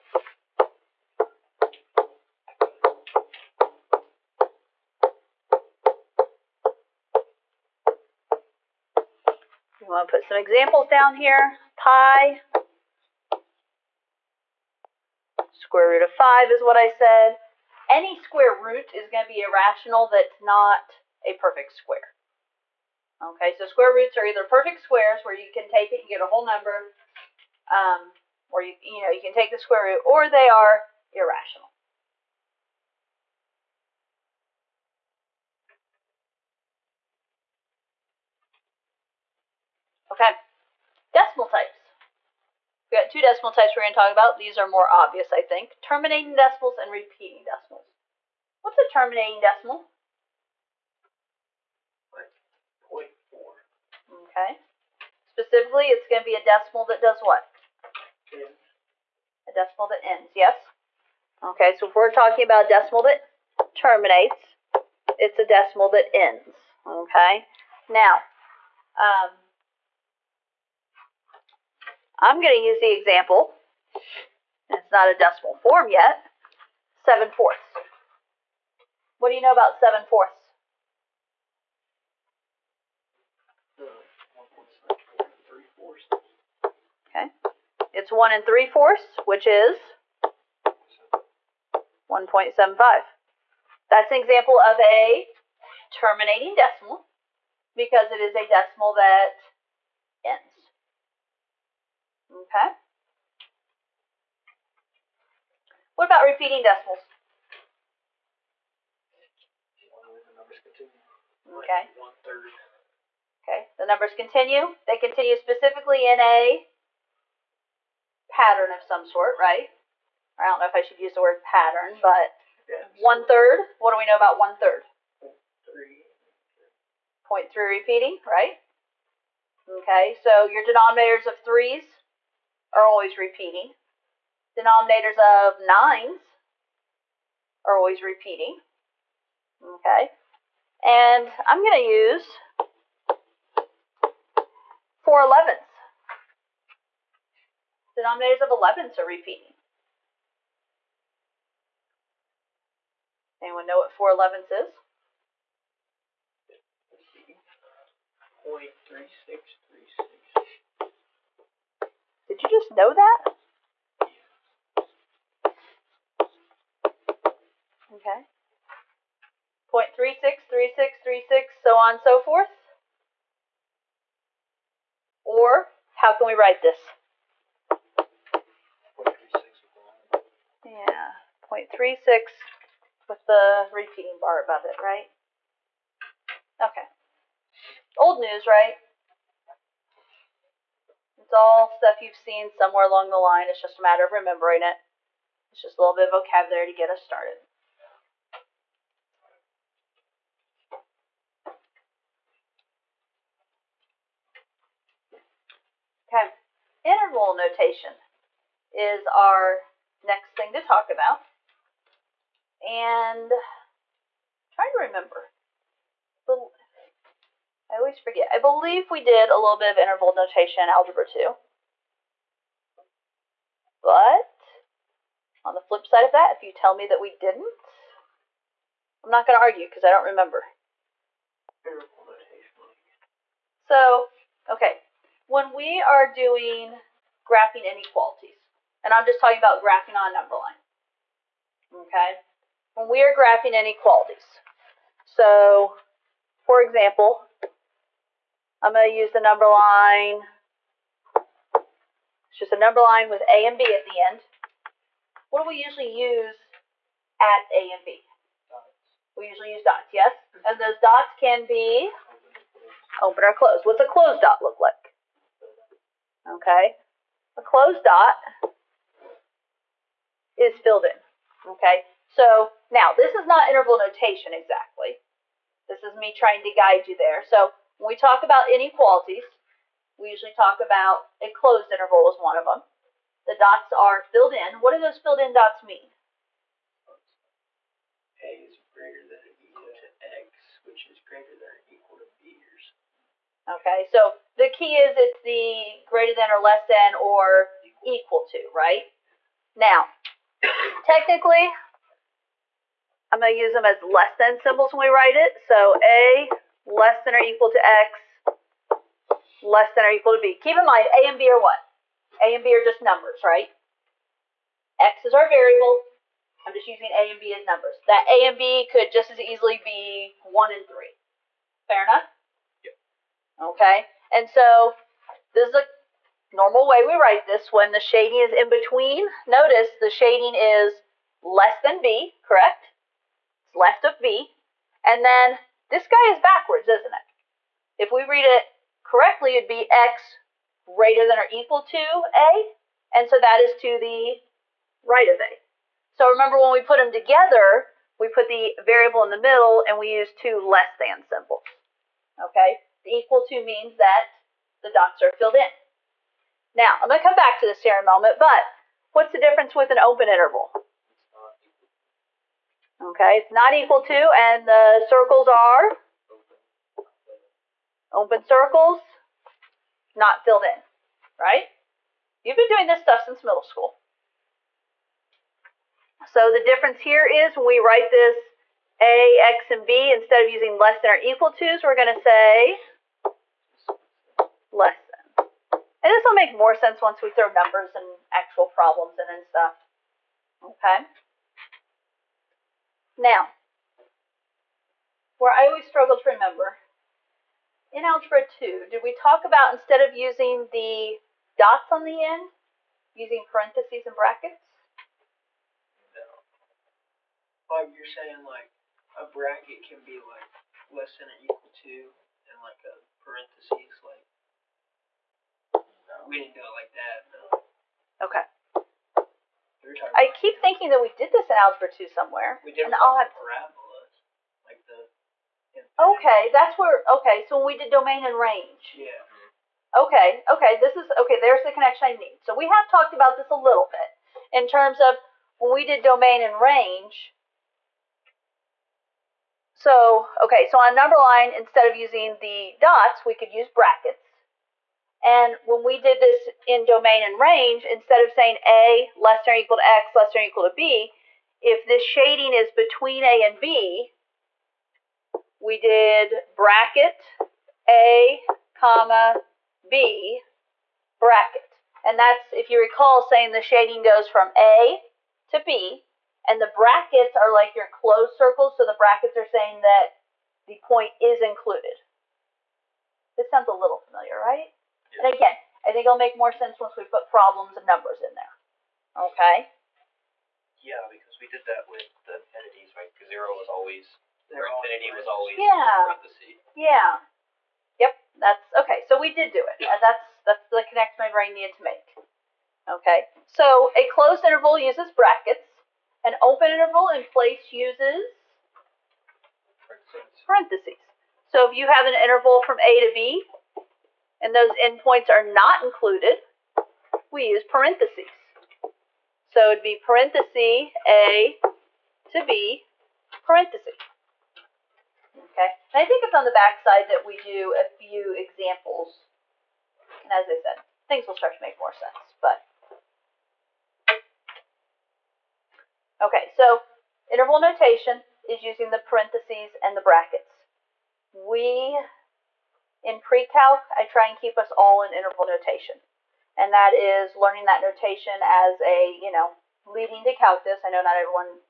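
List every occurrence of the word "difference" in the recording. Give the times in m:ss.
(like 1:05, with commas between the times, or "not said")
5:59, 6:16.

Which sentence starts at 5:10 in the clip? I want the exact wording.
Keep in mind, a and b are what?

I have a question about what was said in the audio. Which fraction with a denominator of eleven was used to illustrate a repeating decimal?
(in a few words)
Four elevenths.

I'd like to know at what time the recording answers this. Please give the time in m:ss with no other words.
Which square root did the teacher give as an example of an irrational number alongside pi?
0:15.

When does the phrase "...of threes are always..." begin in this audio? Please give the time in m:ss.
2:11.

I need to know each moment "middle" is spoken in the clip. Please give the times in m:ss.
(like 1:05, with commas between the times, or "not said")
5:49, 6:13.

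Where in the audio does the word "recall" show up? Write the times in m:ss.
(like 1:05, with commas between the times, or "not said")
7:42.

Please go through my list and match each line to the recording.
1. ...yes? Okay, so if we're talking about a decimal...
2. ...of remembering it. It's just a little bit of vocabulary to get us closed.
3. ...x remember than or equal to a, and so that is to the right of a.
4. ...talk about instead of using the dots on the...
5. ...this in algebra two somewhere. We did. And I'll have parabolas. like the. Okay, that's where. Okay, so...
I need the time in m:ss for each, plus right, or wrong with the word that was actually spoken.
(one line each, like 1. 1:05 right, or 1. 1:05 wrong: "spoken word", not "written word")
1. 1:00 right
2. 3:14 wrong: "started", not "closed"
3. 5:39 wrong: "greater", not "remember"
4. 6:38 right
5. 7:01 right.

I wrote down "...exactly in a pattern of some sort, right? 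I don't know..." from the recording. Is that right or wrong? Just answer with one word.
wrong.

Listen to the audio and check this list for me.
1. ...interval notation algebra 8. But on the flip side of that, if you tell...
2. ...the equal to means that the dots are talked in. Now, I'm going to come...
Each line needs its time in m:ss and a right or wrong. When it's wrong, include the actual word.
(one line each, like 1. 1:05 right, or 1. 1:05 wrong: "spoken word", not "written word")
1. 3:39 wrong: "2", not "8"
2. 5:52 wrong: "filled", not "talked".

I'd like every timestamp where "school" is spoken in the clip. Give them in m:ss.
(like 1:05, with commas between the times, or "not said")
6:13.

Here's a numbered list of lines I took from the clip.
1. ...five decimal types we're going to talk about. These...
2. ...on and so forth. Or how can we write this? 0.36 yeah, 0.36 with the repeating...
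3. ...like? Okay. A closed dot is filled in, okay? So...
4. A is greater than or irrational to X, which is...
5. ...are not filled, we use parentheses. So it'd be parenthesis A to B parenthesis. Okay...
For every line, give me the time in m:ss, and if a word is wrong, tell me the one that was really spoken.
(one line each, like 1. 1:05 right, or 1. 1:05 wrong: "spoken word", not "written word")
1. 0:43 wrong: "two", not "five"
2. 2:51 right
3. 4:24 right
4. 4:48 wrong: "equal", not "irrational"
5. 8:25 wrong: "included", not "filled".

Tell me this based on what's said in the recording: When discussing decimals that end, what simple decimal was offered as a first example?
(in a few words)
0.4.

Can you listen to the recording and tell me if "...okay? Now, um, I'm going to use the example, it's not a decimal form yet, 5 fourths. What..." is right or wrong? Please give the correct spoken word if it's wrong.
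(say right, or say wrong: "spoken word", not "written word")
wrong: "7", not "5".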